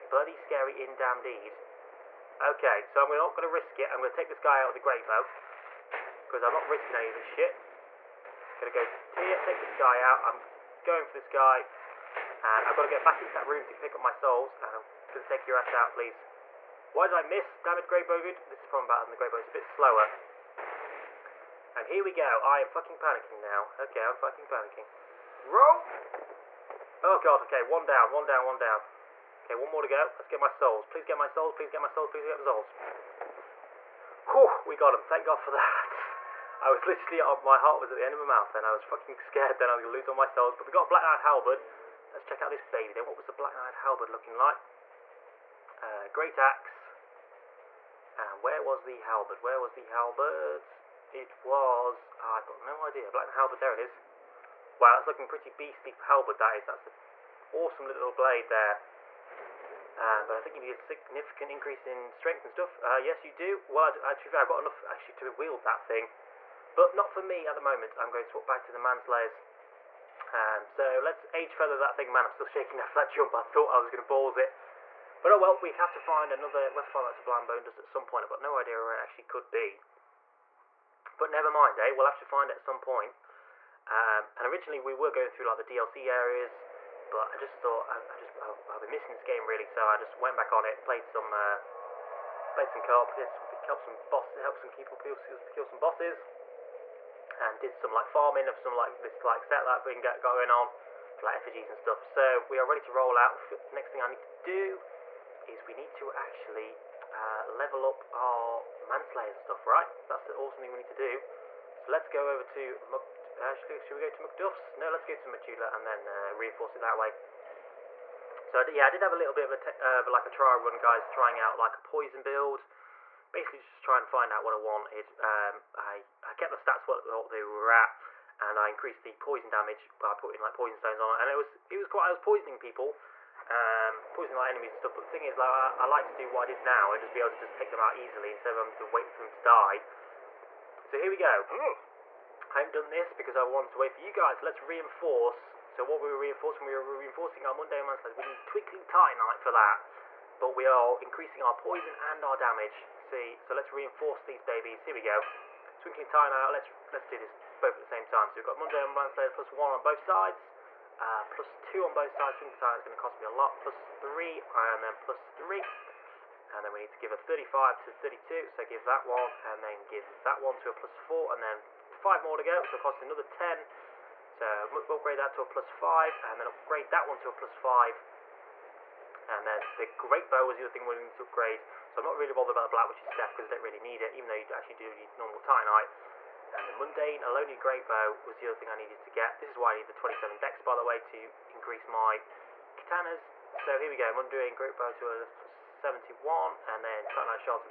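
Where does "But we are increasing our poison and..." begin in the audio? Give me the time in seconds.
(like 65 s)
150 s.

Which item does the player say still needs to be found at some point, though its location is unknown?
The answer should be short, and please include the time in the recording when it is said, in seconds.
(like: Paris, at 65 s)
Sublime Bone Dust, at 77 s.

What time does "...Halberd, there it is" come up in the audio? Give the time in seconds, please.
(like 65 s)
53 s.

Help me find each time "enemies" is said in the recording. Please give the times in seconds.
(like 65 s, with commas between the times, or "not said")
134 s.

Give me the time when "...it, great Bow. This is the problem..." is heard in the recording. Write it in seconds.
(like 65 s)
17 s.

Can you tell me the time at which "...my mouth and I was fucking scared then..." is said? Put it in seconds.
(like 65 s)
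38 s.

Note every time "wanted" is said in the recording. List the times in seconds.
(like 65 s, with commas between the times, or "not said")
124 s, 143 s.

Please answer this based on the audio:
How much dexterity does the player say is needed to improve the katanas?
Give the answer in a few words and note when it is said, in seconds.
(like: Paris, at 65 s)
27, at 189 s.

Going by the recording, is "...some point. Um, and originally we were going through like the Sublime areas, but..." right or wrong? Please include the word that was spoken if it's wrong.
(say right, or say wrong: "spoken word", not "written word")
wrong: "DLC", not "Sublime".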